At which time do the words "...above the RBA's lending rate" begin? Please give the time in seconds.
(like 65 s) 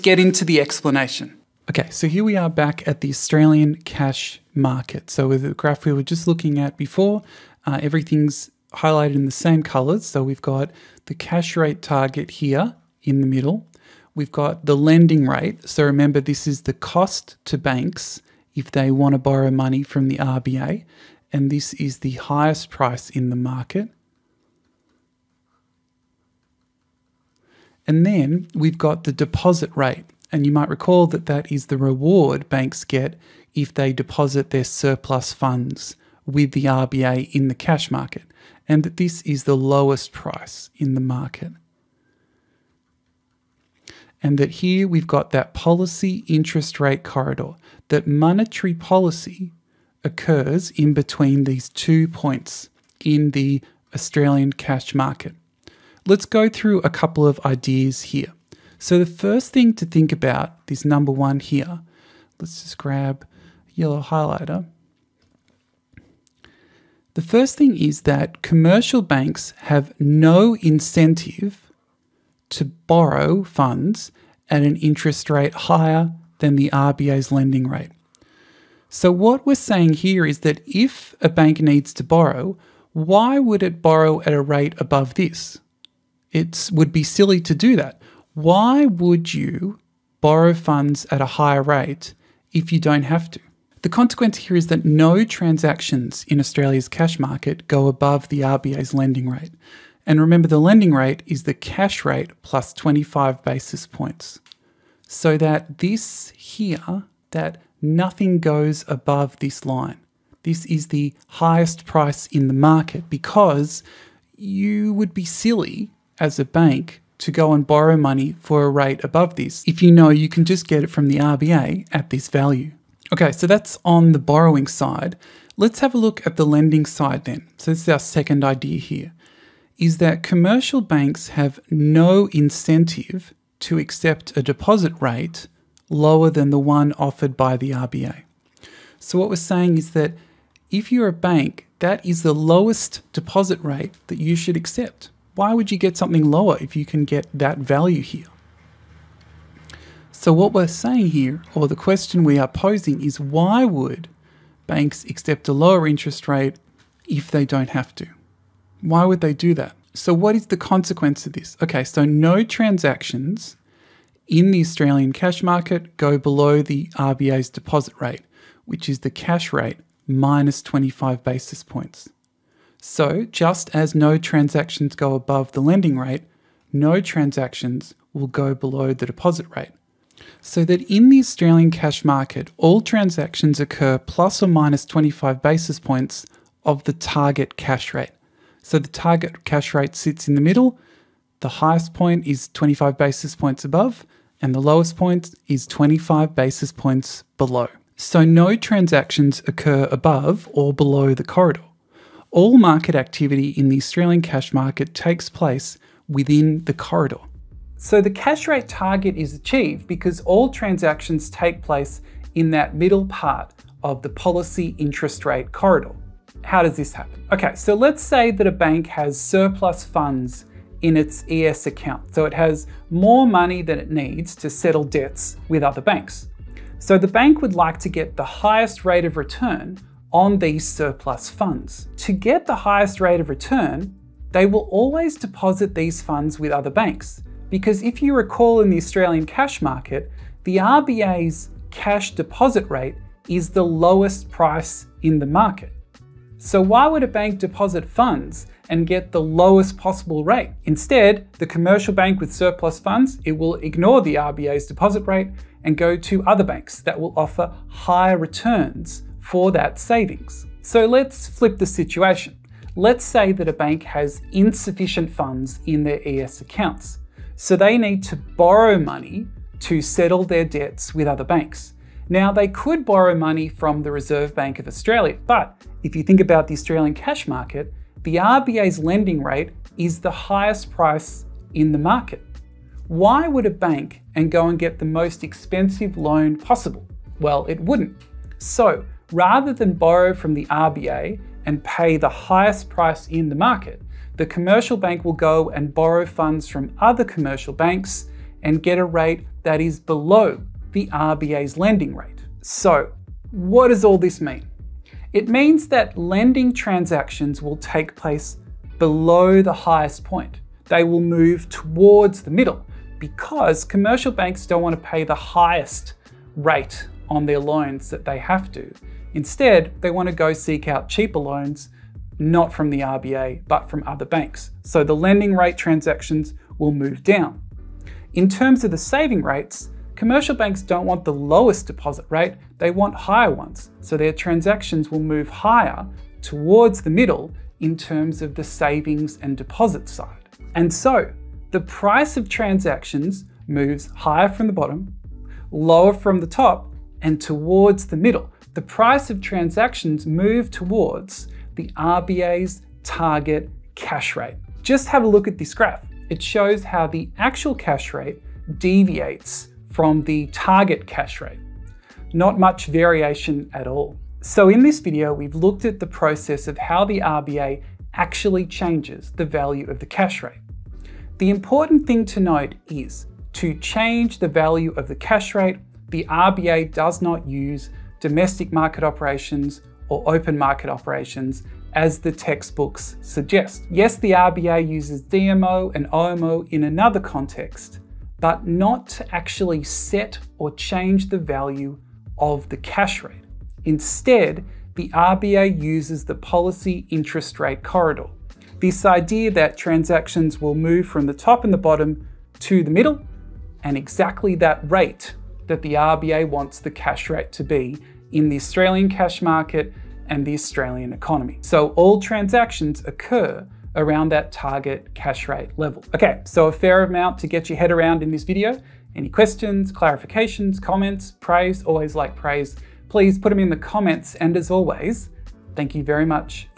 97 s.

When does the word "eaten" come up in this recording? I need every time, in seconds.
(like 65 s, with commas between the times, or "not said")
not said.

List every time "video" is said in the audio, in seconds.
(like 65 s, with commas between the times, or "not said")
364 s, 418 s.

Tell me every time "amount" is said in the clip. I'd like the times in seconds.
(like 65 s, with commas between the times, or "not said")
416 s.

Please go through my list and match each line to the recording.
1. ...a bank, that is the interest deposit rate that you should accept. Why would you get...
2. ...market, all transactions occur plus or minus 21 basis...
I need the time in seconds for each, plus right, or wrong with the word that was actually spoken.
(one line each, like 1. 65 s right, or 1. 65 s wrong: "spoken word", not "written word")
1. 141 s wrong: "lowest", not "interest"
2. 182 s wrong: "25", not "21".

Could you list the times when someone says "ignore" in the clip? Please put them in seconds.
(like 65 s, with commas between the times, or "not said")
253 s.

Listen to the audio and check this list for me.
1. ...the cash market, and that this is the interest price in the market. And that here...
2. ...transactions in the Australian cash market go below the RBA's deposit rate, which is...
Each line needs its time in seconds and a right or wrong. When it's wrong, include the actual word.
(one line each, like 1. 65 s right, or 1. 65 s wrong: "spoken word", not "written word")
1. 37 s wrong: "lowest", not "interest"
2. 162 s right.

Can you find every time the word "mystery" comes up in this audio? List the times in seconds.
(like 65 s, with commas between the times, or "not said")
not said.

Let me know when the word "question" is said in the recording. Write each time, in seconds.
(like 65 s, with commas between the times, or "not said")
151 s, 419 s.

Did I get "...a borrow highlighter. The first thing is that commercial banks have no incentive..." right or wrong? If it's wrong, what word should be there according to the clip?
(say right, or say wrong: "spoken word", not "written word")
wrong: "yellow", not "borrow".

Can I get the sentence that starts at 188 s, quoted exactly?
So the target cash rate sits in the middle.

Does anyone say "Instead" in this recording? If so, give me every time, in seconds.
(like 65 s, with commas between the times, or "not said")
250 s, 319 s, 393 s.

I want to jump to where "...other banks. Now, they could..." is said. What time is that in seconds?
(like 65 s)
271 s.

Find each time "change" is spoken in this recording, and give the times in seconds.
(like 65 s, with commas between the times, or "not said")
368 s, 373 s, 390 s.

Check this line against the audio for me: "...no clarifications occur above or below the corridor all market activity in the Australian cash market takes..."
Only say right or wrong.
wrong.